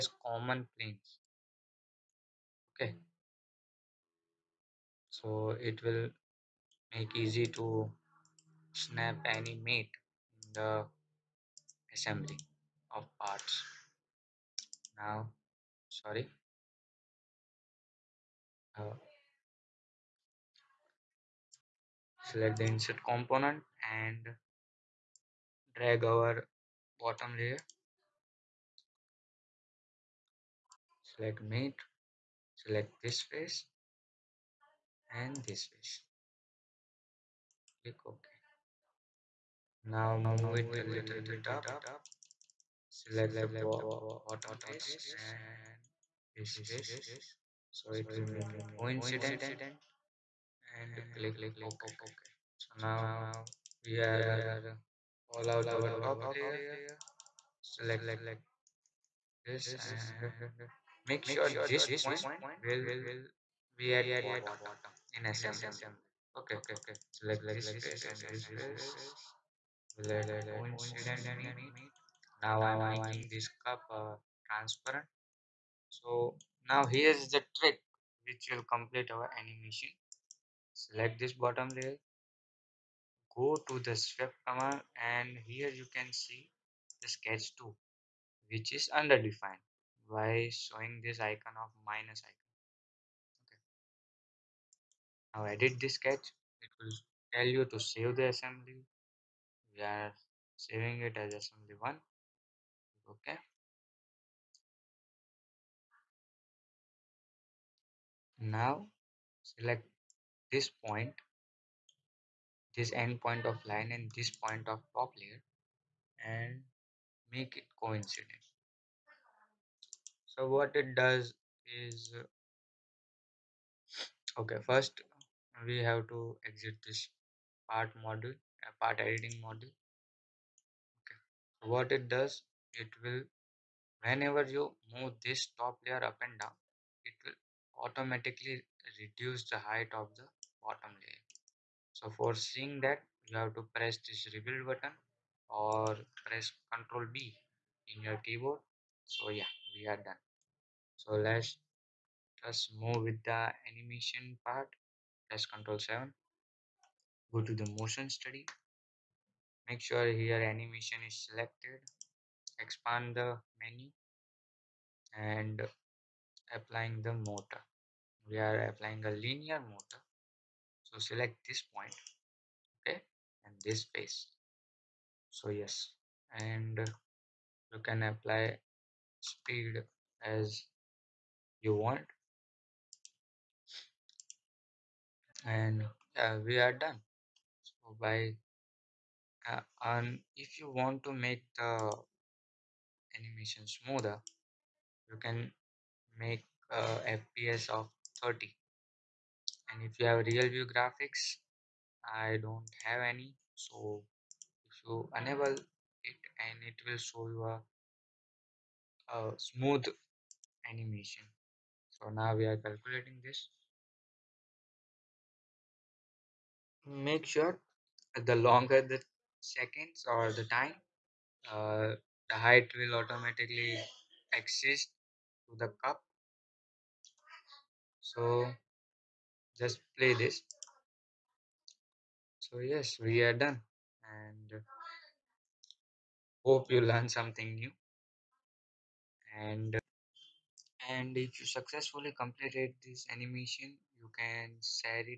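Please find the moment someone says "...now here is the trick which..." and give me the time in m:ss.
1:16.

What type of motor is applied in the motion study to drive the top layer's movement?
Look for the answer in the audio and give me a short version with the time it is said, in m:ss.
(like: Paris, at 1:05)
linear motor, at 2:49.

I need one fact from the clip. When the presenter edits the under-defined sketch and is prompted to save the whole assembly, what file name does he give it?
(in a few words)
assembly1.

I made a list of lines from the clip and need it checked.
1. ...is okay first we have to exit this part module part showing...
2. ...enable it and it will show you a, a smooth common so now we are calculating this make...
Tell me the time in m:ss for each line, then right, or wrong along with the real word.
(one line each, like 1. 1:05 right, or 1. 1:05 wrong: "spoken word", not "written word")
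1. 2:01 wrong: "editing", not "showing"
2. 3:25 wrong: "animation", not "common".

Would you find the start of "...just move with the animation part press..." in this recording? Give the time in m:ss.
2:32.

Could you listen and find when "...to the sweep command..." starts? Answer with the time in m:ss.
1:23.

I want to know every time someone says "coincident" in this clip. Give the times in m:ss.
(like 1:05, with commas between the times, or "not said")
0:48, 1:10, 1:57.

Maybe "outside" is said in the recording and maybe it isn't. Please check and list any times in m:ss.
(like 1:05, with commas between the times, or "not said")
not said.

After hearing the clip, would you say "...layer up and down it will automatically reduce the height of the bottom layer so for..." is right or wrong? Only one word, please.
right.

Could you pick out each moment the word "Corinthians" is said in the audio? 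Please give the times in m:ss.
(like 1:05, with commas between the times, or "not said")
not said.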